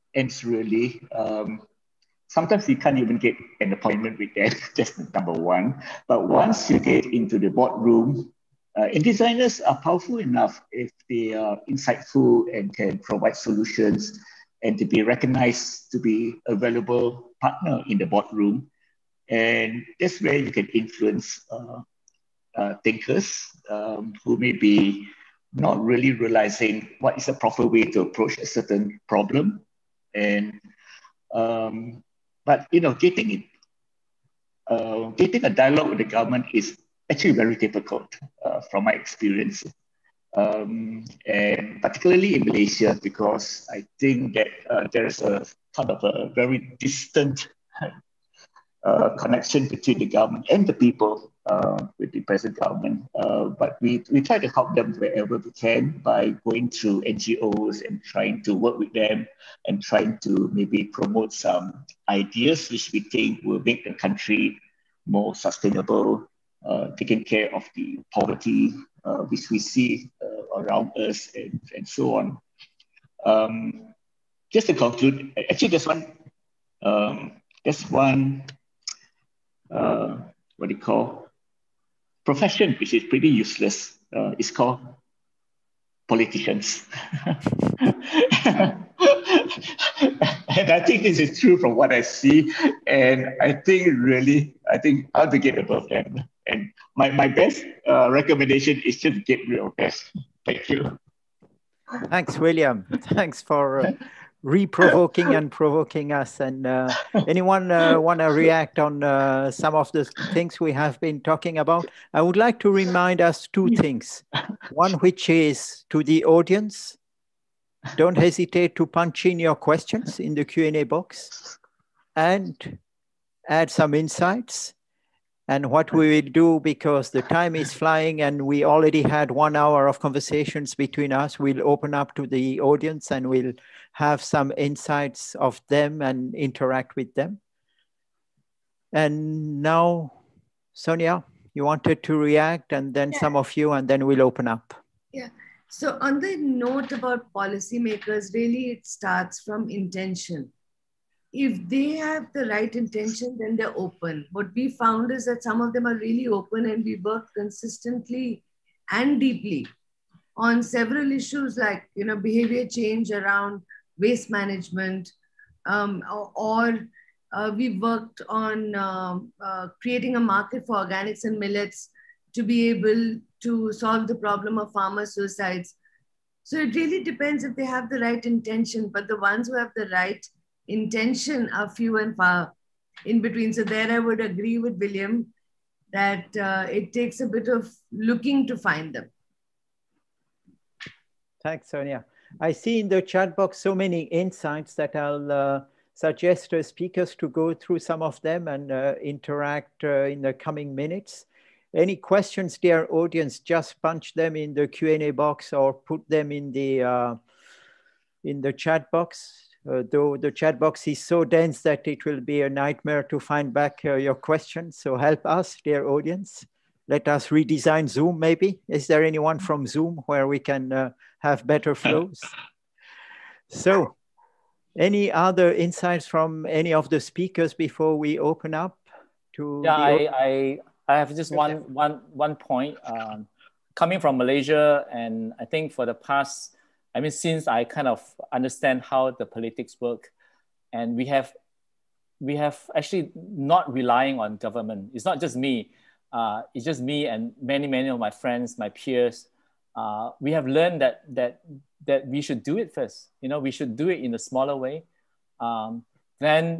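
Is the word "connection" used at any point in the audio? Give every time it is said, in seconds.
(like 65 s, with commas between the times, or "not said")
49 s.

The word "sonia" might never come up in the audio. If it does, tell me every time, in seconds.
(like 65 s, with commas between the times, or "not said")
140 s, 191 s.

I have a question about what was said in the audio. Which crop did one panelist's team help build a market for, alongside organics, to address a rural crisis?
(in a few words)
Millets.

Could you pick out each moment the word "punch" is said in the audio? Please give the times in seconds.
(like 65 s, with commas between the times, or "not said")
118 s, 203 s.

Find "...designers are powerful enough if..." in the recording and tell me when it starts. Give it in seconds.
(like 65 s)
9 s.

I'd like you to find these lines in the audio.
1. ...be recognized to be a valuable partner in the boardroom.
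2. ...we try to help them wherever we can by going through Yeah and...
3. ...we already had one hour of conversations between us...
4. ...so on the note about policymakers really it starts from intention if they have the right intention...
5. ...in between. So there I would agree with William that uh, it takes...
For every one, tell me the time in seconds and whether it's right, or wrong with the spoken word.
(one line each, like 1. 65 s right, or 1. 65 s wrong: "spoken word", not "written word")
1. 14 s right
2. 54 s wrong: "NGOs", not "Yeah"
3. 128 s right
4. 145 s right
5. 183 s right.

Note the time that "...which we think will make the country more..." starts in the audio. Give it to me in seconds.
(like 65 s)
62 s.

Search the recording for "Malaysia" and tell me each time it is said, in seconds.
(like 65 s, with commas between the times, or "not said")
42 s, 234 s.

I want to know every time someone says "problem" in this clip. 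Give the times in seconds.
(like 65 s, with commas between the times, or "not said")
29 s, 174 s.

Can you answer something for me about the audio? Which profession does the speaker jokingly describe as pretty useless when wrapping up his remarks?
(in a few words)
Politicians.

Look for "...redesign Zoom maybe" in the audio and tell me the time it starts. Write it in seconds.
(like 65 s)
217 s.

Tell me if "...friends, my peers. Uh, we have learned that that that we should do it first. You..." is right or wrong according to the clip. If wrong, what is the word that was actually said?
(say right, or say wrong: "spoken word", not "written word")
right.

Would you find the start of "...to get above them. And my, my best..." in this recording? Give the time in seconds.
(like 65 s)
95 s.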